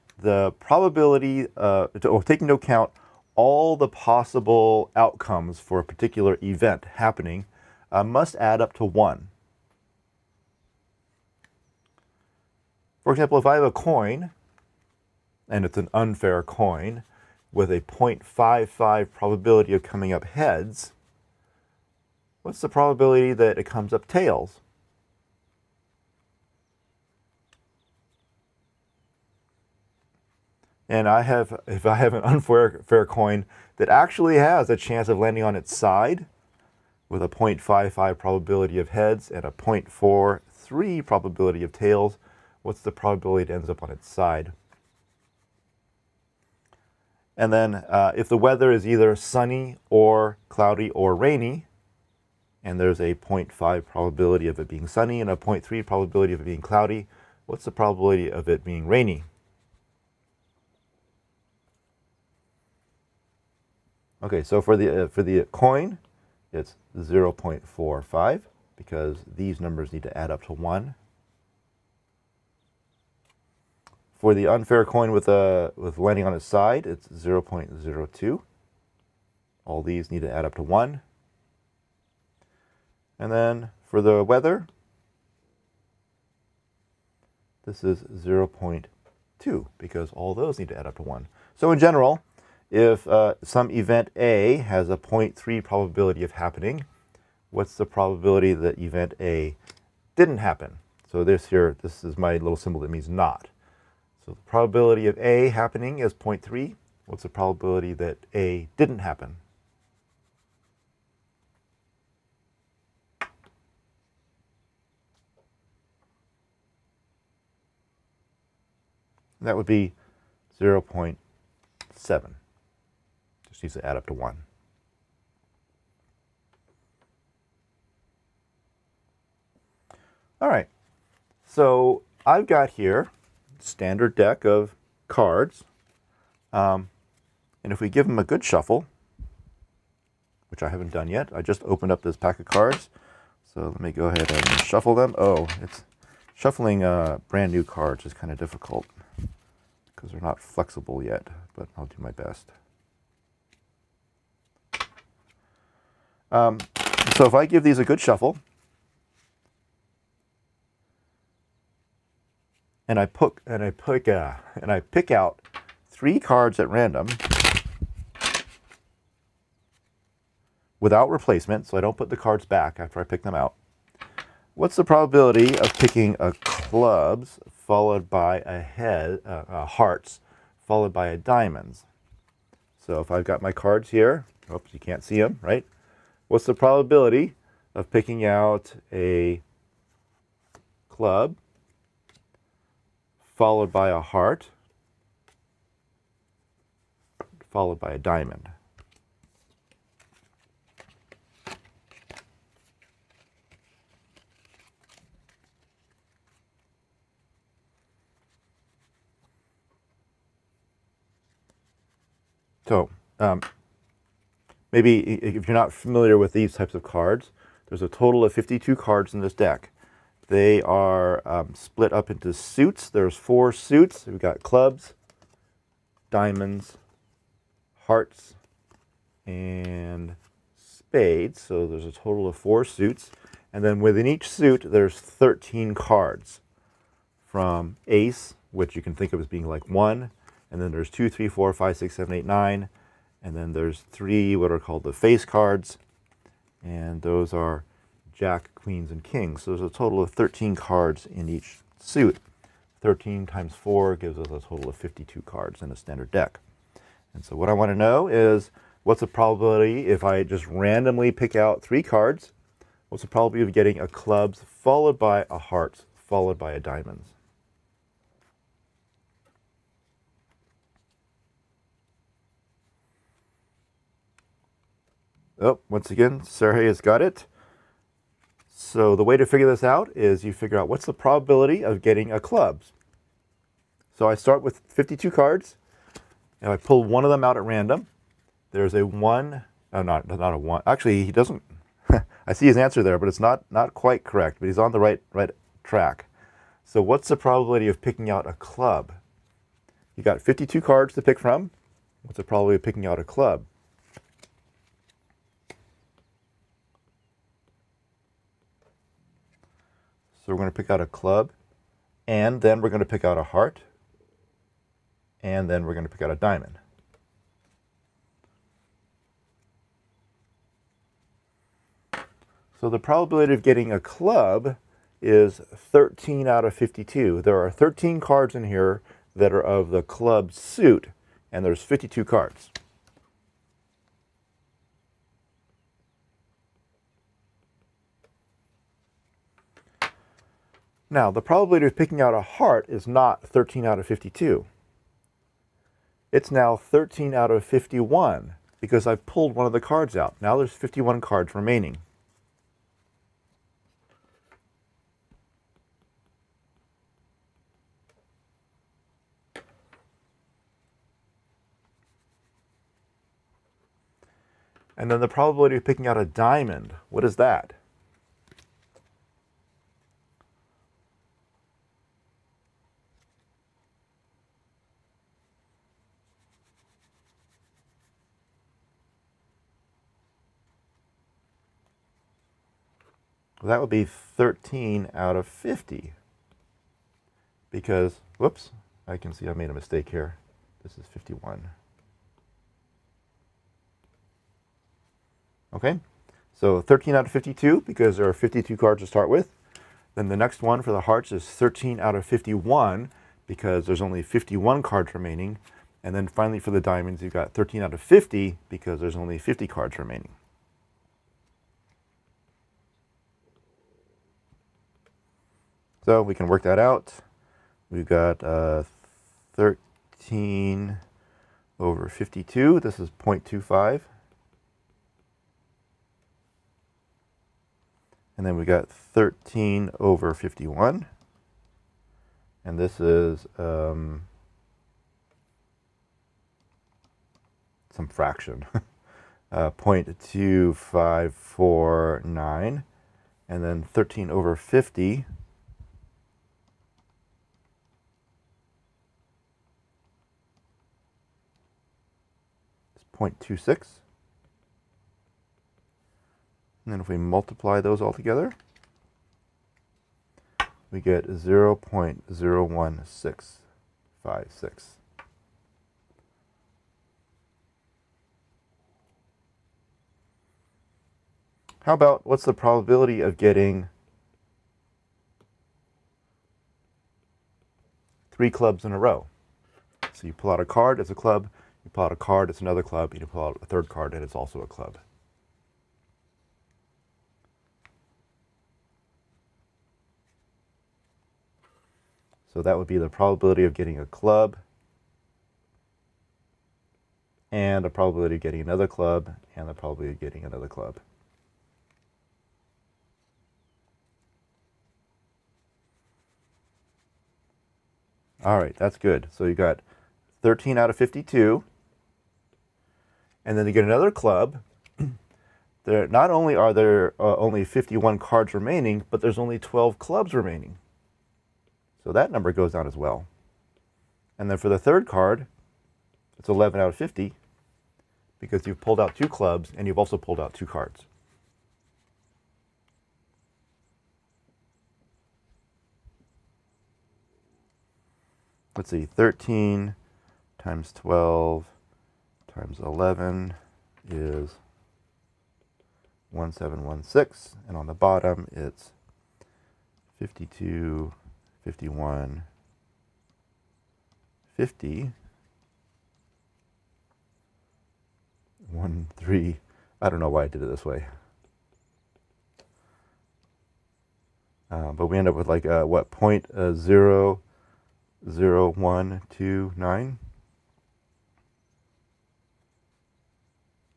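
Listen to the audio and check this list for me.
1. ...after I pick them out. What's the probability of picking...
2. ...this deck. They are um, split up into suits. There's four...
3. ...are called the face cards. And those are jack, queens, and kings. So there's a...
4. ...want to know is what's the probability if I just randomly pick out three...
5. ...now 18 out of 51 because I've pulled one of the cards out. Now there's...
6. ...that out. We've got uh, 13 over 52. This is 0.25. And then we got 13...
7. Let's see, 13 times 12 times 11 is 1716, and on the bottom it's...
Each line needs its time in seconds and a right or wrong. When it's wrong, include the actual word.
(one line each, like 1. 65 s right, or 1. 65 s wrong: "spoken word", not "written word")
1. 172 s right
2. 219 s right
3. 244 s right
4. 257 s right
5. 346 s wrong: "13", not "18"
6. 416 s right
7. 538 s right.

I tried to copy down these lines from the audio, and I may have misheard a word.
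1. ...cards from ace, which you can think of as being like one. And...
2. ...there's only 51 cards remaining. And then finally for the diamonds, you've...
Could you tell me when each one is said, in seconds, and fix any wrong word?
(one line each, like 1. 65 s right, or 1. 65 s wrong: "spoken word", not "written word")
1. 235 s right
2. 403 s right.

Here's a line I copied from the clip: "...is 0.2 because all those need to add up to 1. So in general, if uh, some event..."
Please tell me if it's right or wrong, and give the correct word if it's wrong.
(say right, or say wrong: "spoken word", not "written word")
right.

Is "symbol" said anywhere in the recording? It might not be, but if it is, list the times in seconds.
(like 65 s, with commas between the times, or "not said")
102 s.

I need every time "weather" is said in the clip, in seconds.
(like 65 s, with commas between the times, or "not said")
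48 s, 84 s.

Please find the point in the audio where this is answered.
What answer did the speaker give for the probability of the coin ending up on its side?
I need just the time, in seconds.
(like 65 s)
77 s.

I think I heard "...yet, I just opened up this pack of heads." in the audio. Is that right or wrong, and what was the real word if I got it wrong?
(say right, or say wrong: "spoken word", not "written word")
wrong: "cards", not "heads".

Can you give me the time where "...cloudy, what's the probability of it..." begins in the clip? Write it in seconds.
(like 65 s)
56 s.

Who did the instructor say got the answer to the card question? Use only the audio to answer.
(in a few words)
Sergey.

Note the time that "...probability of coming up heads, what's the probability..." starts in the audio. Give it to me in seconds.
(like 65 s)
19 s.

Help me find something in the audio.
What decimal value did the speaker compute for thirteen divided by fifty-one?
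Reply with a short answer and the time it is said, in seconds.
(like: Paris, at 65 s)
0.2549, at 439 s.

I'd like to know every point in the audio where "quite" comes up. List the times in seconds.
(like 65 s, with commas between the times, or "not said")
293 s.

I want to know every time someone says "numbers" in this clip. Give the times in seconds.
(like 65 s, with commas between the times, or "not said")
69 s, 522 s.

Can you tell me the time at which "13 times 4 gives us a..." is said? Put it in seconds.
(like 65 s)
252 s.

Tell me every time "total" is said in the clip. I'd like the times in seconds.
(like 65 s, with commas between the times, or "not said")
217 s, 231 s, 249 s, 254 s.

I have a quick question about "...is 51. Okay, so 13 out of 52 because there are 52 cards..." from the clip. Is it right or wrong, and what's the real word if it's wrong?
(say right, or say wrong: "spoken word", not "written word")
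right.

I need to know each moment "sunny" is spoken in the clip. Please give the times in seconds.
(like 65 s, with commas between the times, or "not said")
49 s, 54 s.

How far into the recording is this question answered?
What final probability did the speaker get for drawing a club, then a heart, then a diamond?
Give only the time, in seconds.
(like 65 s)
461 s.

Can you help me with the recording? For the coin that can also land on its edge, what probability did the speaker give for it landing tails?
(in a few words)
0.43.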